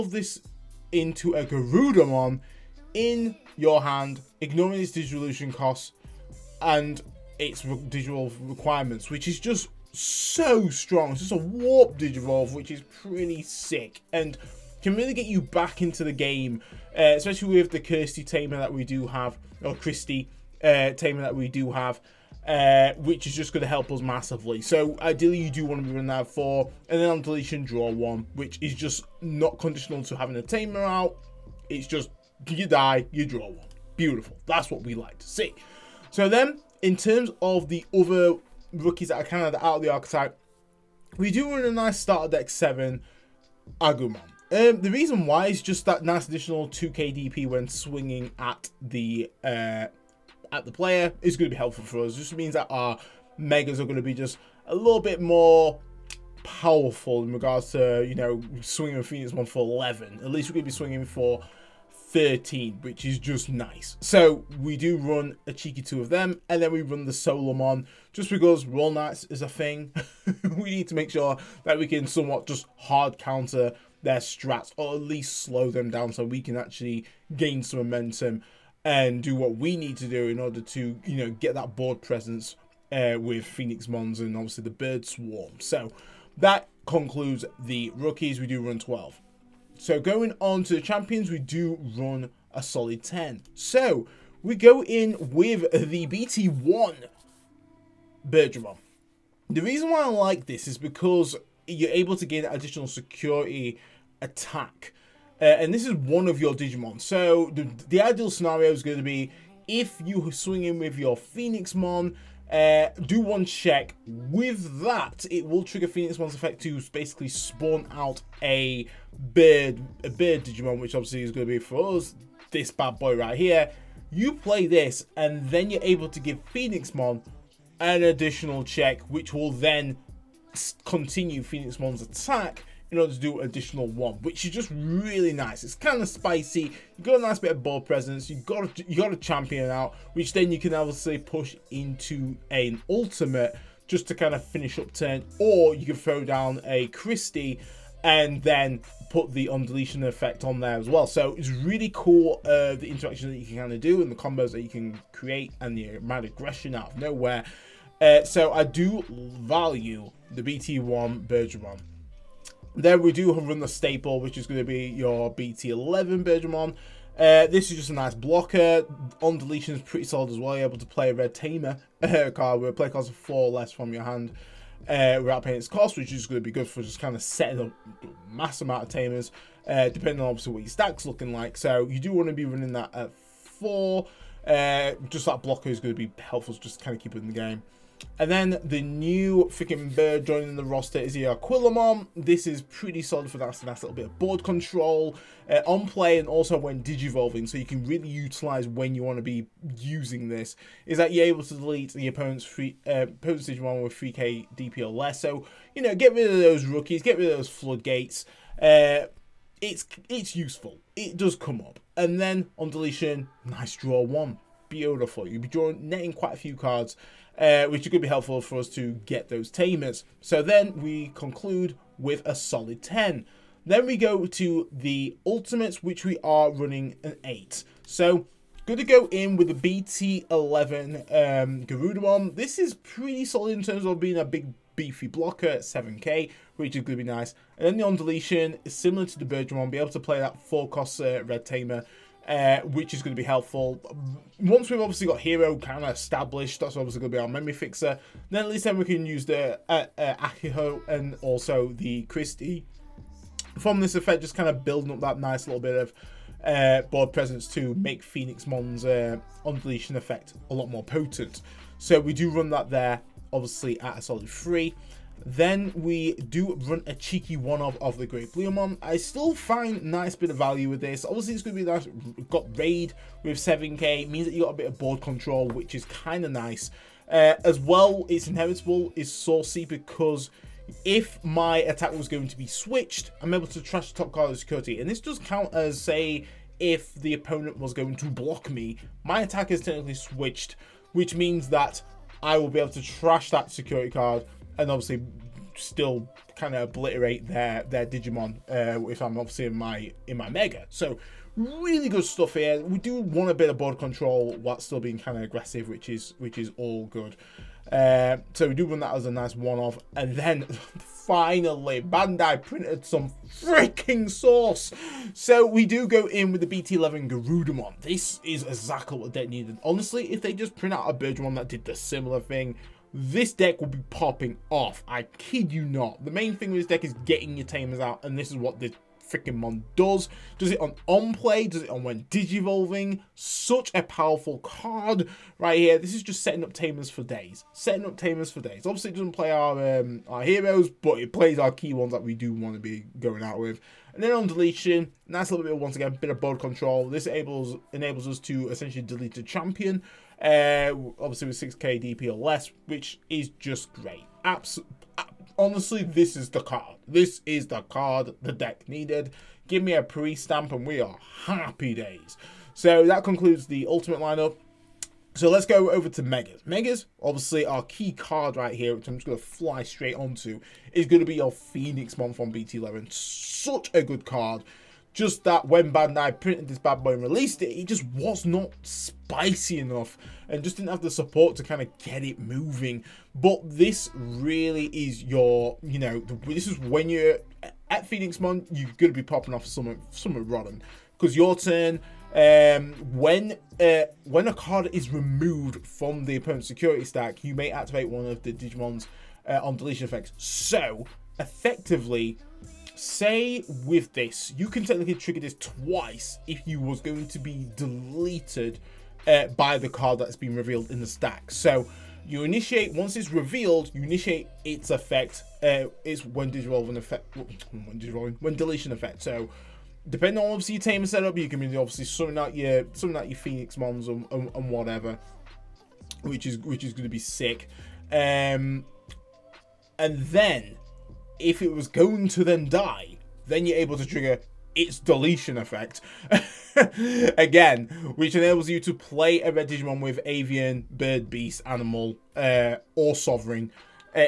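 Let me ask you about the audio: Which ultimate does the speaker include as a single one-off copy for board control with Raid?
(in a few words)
Great Bluemon.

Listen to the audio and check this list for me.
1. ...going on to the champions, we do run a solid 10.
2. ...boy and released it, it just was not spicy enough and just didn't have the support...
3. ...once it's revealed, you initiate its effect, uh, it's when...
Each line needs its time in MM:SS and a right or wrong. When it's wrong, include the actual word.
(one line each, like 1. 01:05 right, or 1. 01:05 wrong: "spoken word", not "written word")
1. 01:29 right
2. 06:16 right
3. 06:52 right.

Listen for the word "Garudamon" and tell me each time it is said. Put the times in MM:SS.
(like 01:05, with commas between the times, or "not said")
00:01, 03:51, 05:17.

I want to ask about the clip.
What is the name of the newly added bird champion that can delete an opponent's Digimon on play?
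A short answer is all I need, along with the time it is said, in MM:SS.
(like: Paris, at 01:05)
Aquilamon, at 03:11.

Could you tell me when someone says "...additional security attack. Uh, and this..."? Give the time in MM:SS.
01:42.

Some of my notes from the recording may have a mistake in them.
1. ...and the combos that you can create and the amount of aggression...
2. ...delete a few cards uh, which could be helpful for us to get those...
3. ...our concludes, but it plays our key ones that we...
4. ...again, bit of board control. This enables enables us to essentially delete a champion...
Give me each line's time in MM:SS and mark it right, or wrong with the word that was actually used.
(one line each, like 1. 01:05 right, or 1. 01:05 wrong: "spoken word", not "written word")
1. 02:34 right
2. 03:36 wrong: "quite", not "delete"
3. 05:40 wrong: "heroes", not "concludes"
4. 05:45 right.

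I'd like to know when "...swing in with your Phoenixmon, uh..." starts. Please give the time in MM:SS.
01:50.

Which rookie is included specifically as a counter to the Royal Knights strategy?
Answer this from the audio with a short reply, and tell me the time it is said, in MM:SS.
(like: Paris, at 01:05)
Solomon, at 01:07.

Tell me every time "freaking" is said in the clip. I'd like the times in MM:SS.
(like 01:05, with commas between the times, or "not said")
03:09, 05:13, 05:29.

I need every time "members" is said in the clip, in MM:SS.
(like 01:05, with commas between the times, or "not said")
not said.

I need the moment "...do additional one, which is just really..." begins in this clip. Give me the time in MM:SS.
02:13.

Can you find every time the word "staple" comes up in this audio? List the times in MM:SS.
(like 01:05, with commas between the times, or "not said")
02:43.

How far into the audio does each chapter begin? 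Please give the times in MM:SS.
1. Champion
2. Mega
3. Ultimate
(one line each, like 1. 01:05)
1. 01:34
2. 06:06
3. 03:46.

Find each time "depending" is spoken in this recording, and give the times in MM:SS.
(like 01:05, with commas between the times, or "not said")
02:59, 06:59.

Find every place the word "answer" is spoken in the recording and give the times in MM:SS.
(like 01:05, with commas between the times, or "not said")
not said.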